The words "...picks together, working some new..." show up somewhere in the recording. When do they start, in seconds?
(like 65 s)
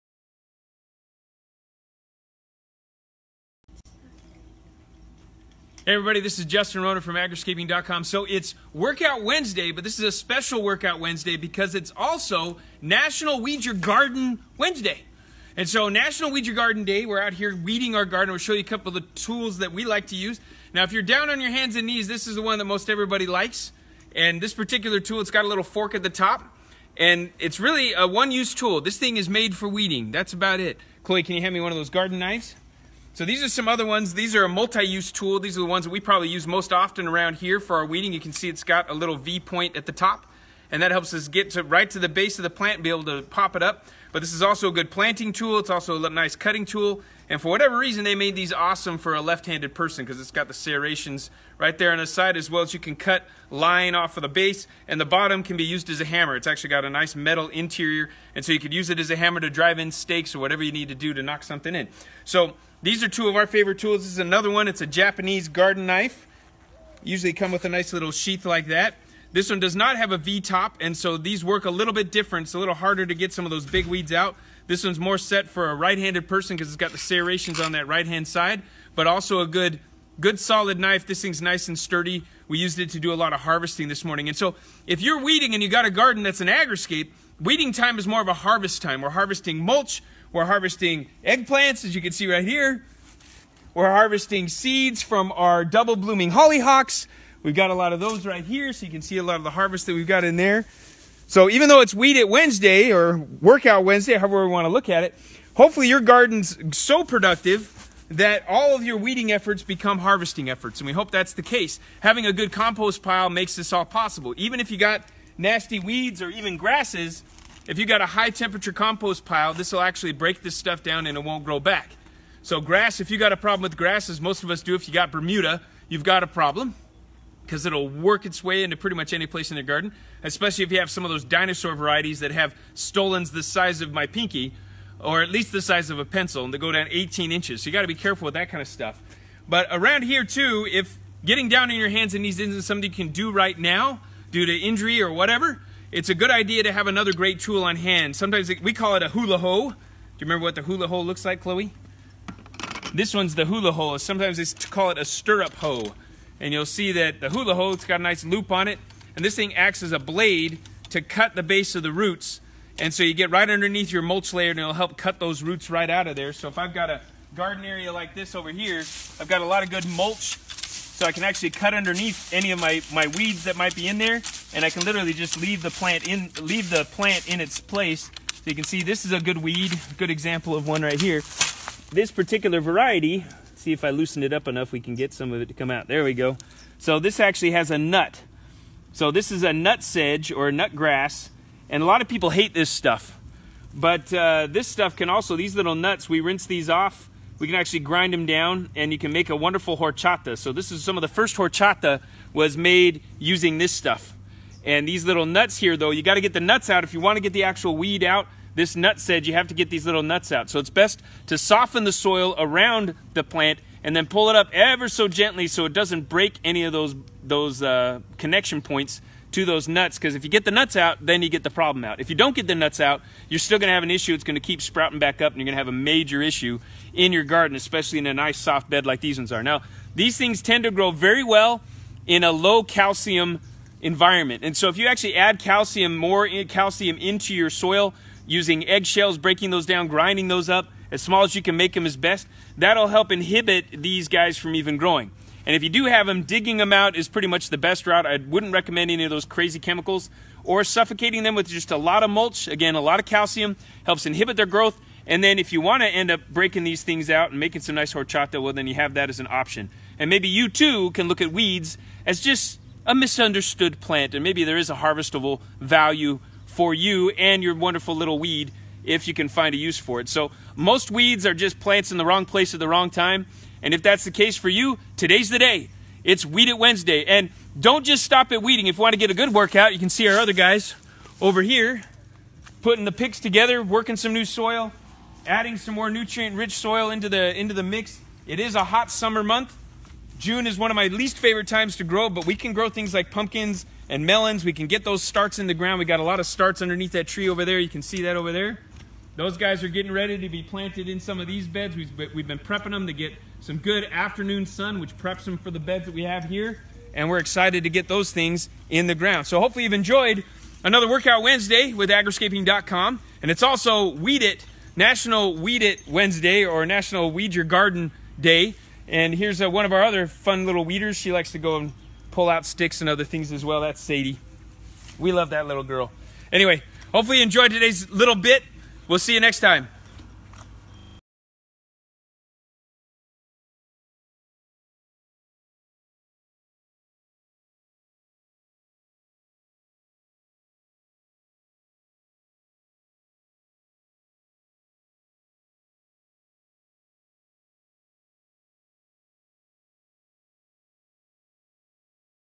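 282 s.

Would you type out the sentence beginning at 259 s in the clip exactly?
And maybe you too can look at weeds as just a misunderstood plant.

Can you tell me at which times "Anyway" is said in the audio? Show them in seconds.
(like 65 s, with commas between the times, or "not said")
326 s.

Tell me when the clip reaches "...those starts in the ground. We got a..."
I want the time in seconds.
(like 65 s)
294 s.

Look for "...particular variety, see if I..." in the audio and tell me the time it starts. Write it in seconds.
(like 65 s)
182 s.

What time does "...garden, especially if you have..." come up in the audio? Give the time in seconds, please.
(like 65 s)
129 s.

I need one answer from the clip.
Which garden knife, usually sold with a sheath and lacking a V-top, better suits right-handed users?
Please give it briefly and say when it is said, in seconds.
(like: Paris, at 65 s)
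Japanese garden knife, at 64 s.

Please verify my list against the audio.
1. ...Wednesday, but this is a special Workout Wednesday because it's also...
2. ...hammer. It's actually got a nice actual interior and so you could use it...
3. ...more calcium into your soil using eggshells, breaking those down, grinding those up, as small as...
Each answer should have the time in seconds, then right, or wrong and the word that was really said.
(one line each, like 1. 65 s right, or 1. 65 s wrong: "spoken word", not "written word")
1. 9 s right
2. 56 s wrong: "metal", not "actual"
3. 235 s right.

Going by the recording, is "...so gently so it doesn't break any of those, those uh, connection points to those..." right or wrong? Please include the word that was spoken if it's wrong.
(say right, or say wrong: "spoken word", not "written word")
right.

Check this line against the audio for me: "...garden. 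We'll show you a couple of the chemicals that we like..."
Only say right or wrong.
wrong.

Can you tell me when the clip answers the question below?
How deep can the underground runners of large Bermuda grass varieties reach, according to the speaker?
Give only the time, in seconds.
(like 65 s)
136 s.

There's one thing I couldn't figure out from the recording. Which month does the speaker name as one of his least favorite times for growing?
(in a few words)
June.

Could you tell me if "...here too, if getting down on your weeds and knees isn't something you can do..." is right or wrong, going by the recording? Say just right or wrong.
wrong.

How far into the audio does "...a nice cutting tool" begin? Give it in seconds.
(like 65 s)
46 s.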